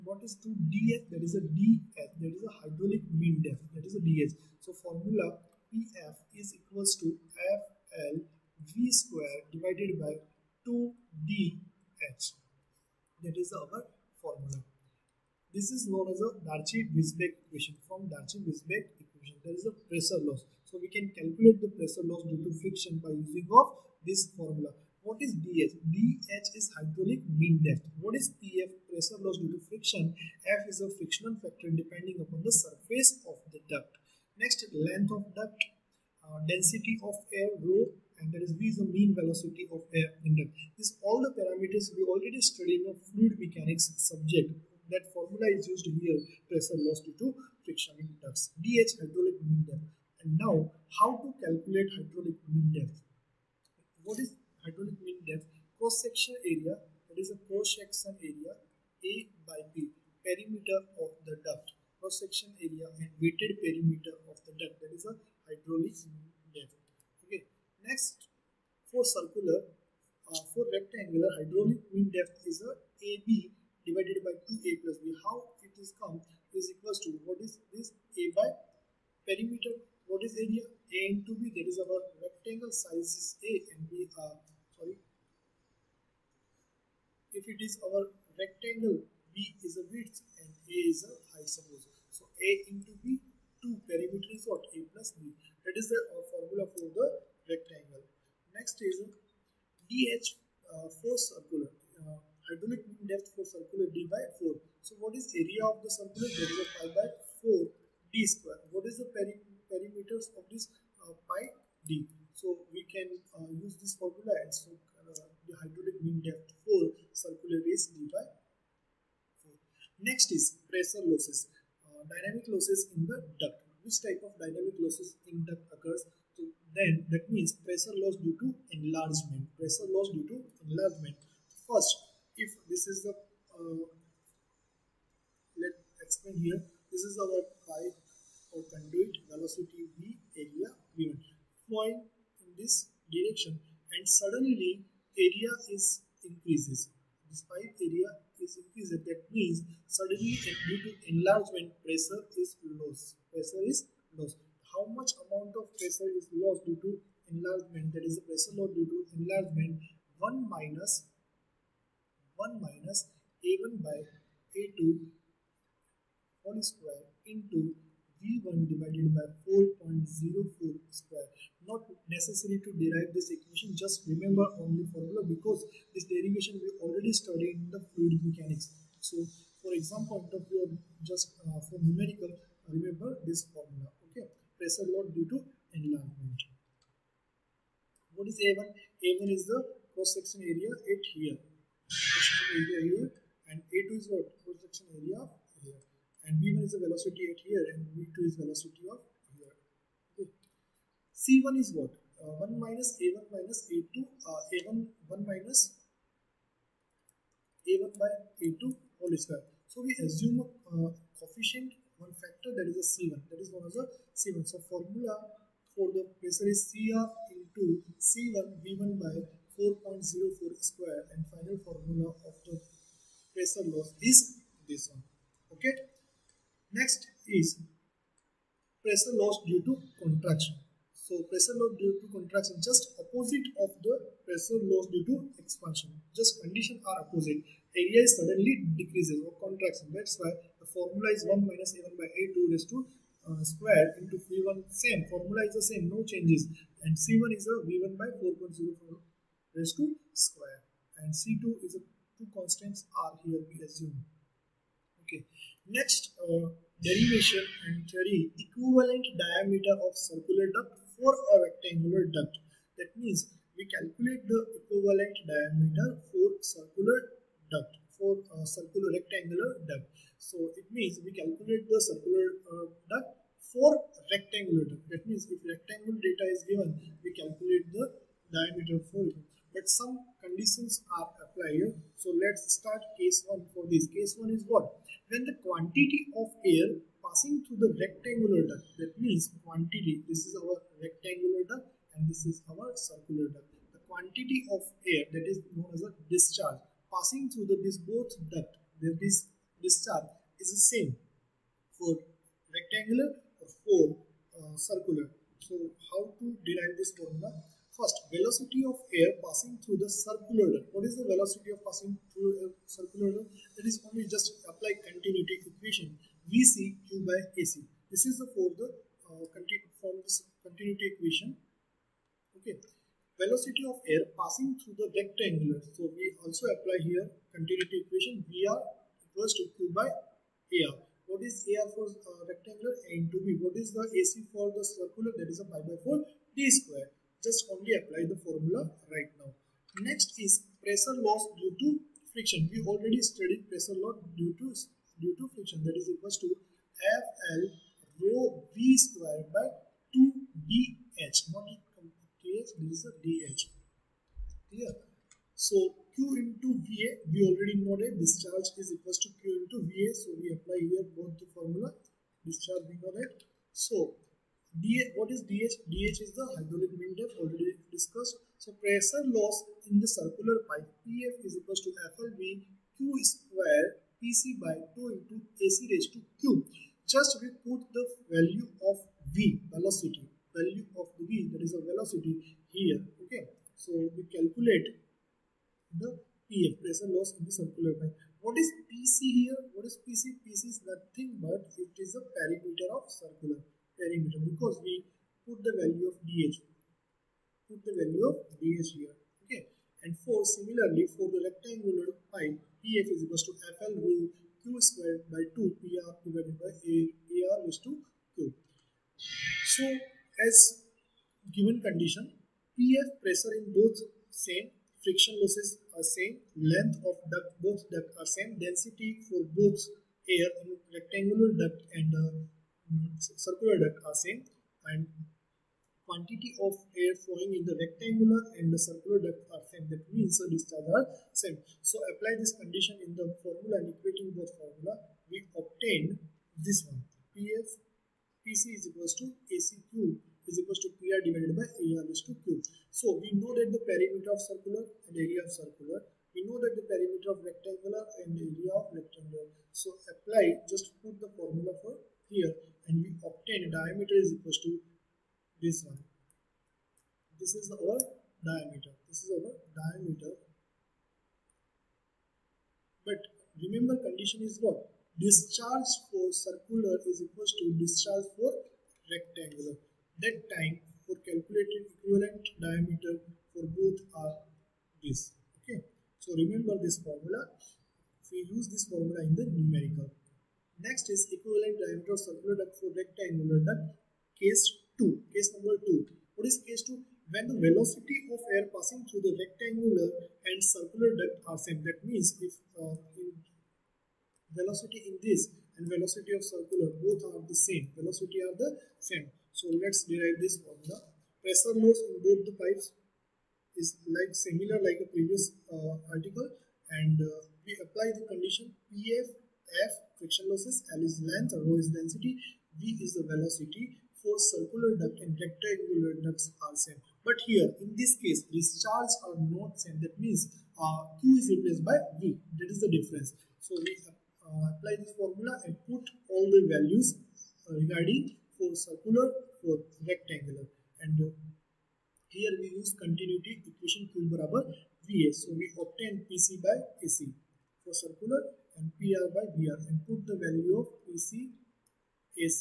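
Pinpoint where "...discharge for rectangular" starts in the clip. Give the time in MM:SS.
07:47.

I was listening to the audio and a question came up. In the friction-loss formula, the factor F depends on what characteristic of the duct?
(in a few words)
the surface of the duct.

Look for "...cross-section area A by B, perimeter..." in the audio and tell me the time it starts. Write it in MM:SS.
00:57.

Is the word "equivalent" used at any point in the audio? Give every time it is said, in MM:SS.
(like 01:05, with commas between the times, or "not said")
04:18, 04:24, 07:51, 08:01.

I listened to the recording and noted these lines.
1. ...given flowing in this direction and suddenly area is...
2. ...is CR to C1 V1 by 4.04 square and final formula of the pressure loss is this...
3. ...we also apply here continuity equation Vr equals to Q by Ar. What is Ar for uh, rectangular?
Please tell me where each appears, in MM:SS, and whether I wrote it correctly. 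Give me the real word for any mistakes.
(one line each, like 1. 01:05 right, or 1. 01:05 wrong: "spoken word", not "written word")
1. 02:20 right
2. 03:36 right
3. 05:25 right.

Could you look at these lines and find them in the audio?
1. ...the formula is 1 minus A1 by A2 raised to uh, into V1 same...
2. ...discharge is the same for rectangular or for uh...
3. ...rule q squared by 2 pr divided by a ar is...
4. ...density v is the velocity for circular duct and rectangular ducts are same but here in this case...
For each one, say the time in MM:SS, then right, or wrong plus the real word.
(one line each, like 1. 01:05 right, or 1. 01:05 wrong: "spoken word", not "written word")
1. 04:00 right
2. 04:59 right
3. 06:43 right
4. 08:31 right.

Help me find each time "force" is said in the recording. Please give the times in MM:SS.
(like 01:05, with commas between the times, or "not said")
01:41.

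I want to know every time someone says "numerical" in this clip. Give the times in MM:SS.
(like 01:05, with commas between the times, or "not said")
03:01, 07:59.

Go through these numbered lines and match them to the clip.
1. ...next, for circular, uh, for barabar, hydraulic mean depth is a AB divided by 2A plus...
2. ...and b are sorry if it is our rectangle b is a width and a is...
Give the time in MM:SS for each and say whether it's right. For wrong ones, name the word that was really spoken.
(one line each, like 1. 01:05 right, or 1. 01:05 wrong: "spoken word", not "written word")
1. 01:07 wrong: "rectangular", not "barabar"
2. 01:23 right.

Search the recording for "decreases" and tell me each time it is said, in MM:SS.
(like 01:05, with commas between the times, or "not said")
03:58.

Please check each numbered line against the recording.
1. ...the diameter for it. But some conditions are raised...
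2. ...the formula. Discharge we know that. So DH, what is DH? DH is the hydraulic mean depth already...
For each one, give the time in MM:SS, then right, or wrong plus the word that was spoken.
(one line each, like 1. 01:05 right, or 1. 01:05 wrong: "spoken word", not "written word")
1. 04:37 wrong: "applied", not "raised"
2. 06:01 right.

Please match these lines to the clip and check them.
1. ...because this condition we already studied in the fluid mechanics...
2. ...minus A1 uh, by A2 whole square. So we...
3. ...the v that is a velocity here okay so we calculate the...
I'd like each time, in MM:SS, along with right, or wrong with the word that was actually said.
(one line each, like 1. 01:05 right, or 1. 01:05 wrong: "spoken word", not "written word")
1. 02:55 wrong: "derivation", not "condition"
2. 03:25 right
3. 06:20 right.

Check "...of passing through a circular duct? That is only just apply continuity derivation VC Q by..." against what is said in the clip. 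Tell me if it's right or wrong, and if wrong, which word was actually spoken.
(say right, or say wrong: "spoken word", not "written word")
wrong: "equation", not "derivation".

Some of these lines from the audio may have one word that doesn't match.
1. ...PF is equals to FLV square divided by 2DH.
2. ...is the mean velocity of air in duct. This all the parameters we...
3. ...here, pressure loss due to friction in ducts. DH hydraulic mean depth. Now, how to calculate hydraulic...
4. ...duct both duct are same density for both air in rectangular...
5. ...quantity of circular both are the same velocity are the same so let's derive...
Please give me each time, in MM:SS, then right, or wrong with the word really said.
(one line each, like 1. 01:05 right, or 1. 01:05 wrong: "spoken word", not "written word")
1. 00:05 right
2. 00:38 right
3. 00:45 right
4. 06:57 right
5. 08:15 wrong: "velocity", not "quantity".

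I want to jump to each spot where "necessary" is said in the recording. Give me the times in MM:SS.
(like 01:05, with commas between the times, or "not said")
02:52.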